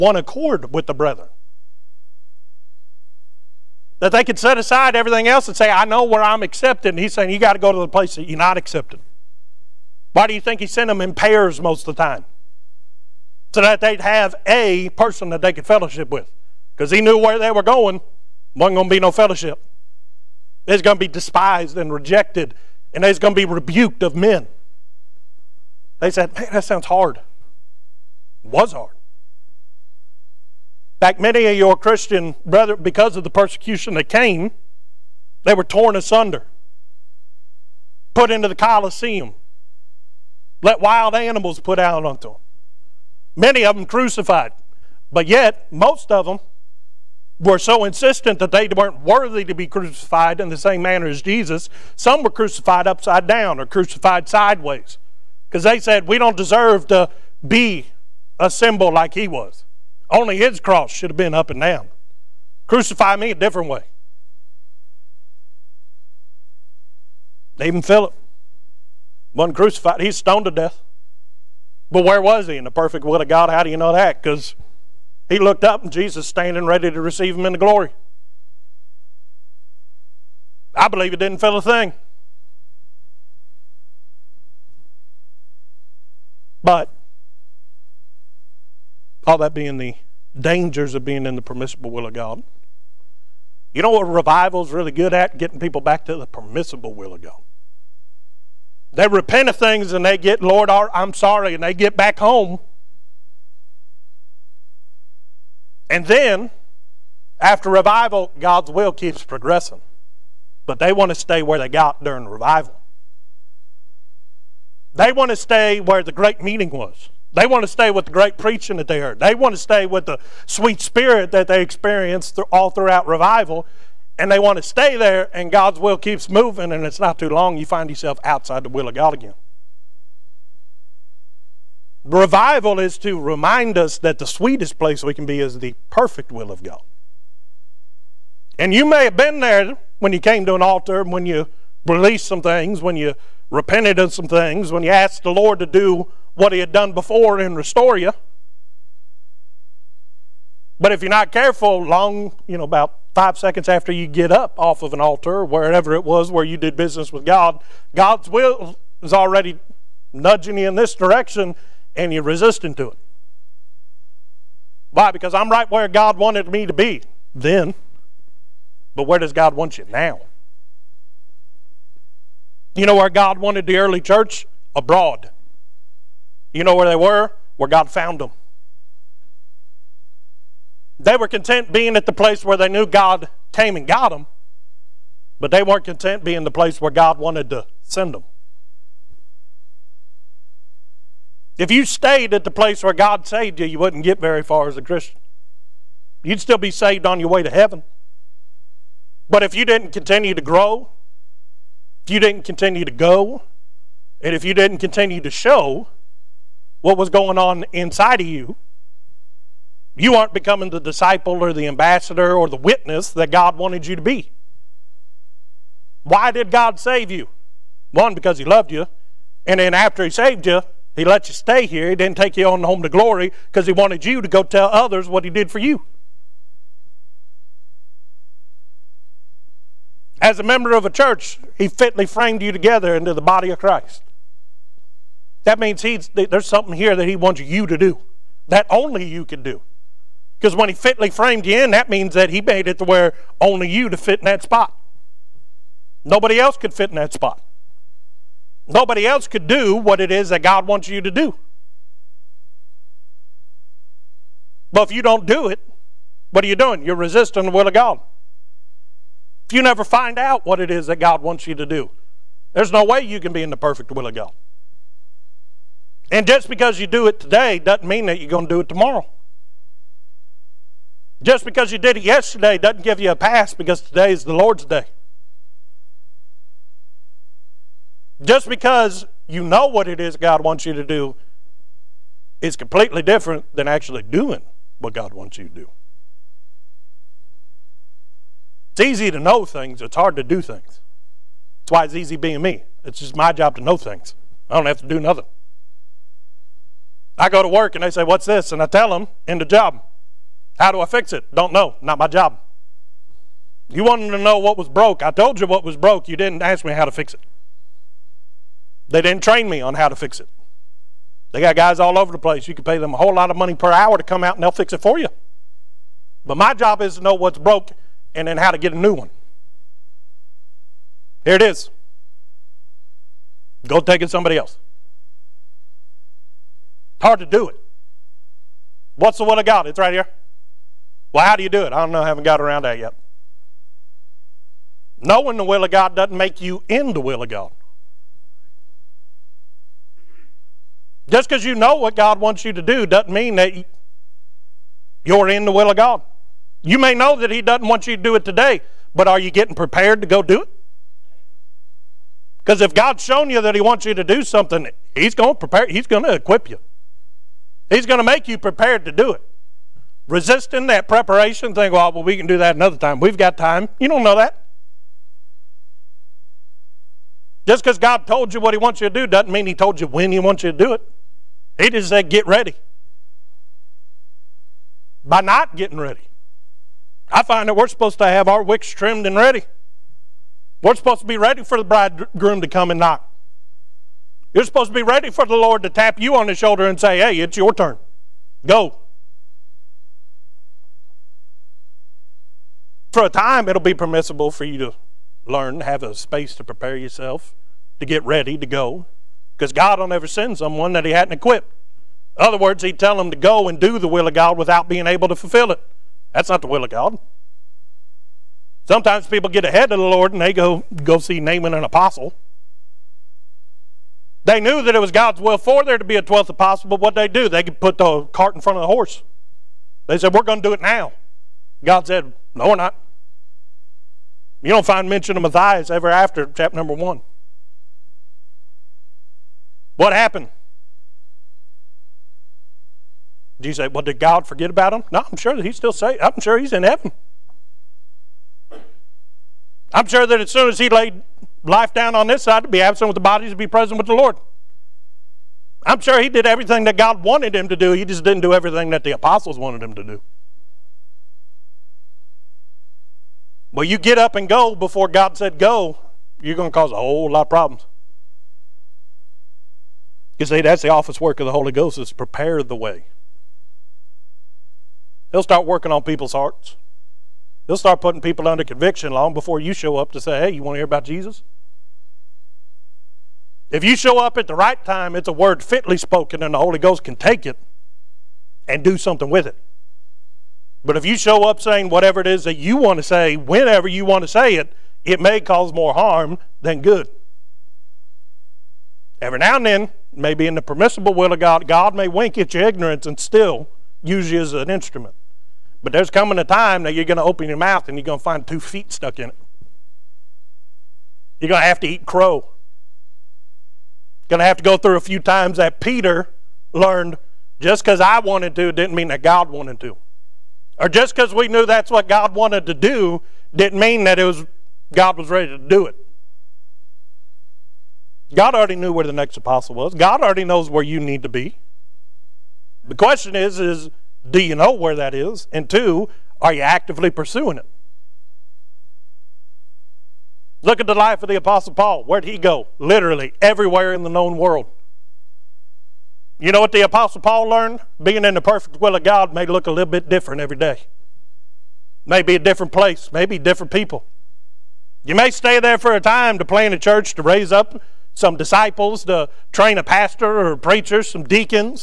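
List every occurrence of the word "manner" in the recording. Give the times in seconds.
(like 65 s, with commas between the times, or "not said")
50 s.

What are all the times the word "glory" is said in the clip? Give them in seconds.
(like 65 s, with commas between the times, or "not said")
77 s, 222 s.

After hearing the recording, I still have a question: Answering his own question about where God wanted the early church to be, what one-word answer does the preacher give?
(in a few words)
Abroad.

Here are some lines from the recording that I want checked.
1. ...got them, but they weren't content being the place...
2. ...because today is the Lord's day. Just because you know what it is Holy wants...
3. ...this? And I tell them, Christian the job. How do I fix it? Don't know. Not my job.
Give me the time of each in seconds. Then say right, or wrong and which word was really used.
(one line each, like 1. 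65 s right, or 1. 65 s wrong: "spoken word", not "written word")
1. 183 s right
2. 273 s wrong: "God", not "Holy"
3. 298 s wrong: "End", not "Christian".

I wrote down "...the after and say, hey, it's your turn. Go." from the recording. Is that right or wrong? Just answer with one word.
wrong.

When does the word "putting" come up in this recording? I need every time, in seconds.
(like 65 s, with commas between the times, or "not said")
467 s.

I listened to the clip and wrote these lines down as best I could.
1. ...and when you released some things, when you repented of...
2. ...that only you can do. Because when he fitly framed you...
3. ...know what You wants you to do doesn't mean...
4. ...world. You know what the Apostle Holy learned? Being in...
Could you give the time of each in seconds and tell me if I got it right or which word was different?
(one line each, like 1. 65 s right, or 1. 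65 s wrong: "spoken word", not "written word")
1. 141 s right
2. 238 s right
3. 341 s wrong: "God", not "You"
4. 534 s wrong: "Paul", not "Holy".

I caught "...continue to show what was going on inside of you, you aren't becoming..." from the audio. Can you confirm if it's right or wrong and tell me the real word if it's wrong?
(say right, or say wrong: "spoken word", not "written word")
right.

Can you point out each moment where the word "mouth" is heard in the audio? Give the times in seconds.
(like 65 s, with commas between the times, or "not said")
497 s.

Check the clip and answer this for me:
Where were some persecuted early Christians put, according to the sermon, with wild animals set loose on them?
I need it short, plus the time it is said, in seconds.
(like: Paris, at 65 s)
The Colosseum, at 38 s.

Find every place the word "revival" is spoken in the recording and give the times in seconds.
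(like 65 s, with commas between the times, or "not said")
94 s, 107 s, 112 s, 123 s, 132 s.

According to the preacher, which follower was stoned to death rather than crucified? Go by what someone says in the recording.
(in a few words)
Philip.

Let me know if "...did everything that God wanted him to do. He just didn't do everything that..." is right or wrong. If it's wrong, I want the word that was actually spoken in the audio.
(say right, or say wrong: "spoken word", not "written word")
right.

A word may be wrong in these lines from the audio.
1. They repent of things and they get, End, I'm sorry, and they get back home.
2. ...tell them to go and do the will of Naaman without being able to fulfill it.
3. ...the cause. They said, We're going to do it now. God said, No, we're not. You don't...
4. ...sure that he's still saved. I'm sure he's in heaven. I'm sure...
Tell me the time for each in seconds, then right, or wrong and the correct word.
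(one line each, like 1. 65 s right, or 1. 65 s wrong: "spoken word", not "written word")
1. 98 s wrong: "Lord", not "End"
2. 402 s wrong: "God", not "Naaman"
3. 418 s wrong: "horse", not "cause"
4. 435 s right.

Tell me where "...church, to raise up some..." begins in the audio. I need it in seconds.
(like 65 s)
546 s.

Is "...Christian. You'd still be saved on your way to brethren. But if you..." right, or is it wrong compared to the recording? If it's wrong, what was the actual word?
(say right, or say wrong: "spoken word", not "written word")
wrong: "heaven", not "brethren".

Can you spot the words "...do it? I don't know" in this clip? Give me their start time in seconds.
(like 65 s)
331 s.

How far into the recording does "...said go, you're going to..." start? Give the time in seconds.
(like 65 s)
455 s.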